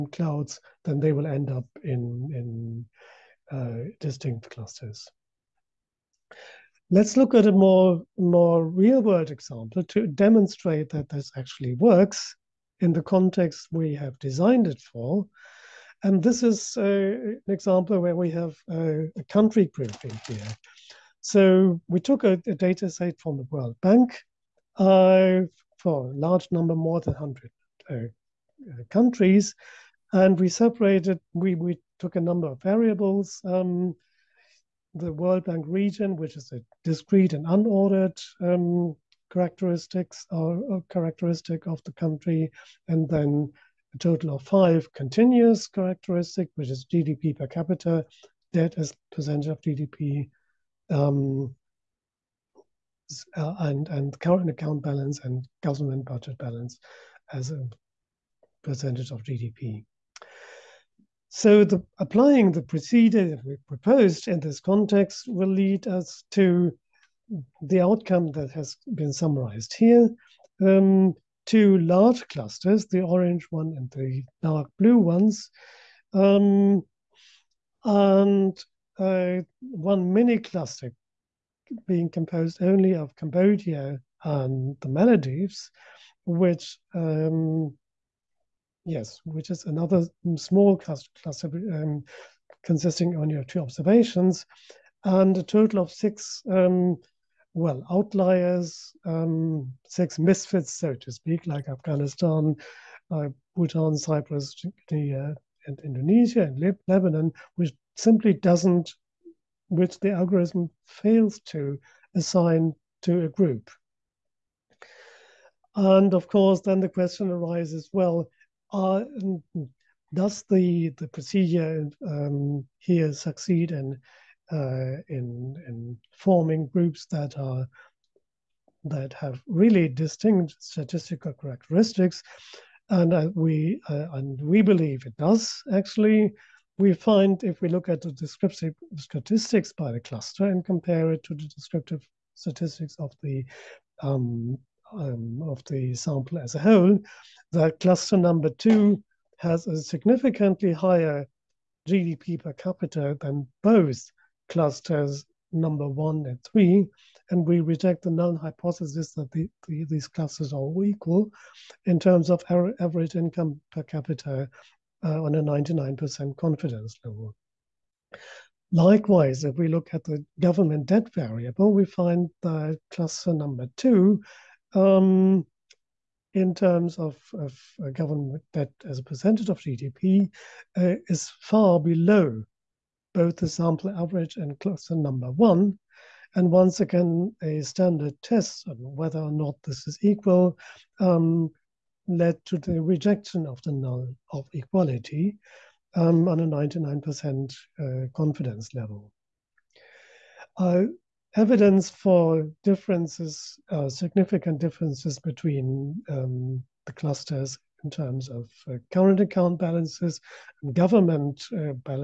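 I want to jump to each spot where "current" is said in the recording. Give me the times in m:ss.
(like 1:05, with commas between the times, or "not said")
0:54, 3:28.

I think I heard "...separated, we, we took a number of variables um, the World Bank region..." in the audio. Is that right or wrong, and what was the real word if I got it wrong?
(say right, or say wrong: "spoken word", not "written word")
right.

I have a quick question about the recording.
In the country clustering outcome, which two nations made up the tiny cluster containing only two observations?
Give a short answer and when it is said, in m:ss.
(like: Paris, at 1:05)
Cambodia and the Maldives, at 1:23.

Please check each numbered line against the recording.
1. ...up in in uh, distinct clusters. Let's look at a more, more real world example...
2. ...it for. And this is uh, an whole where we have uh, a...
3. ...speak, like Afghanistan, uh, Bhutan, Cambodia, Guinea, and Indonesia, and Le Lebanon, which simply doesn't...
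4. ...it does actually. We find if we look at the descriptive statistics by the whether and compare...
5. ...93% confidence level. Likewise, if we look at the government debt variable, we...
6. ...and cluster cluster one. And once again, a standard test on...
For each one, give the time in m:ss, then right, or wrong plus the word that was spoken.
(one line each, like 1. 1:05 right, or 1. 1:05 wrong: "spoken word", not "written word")
1. 0:01 right
2. 0:14 wrong: "example", not "whole"
3. 1:41 wrong: "Cyprus", not "Cambodia"
4. 2:15 wrong: "cluster", not "whether"
5. 2:45 wrong: "99", not "93"
6. 3:04 wrong: "number", not "cluster".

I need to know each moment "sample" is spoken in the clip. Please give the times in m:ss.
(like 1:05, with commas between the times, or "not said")
2:25, 3:03.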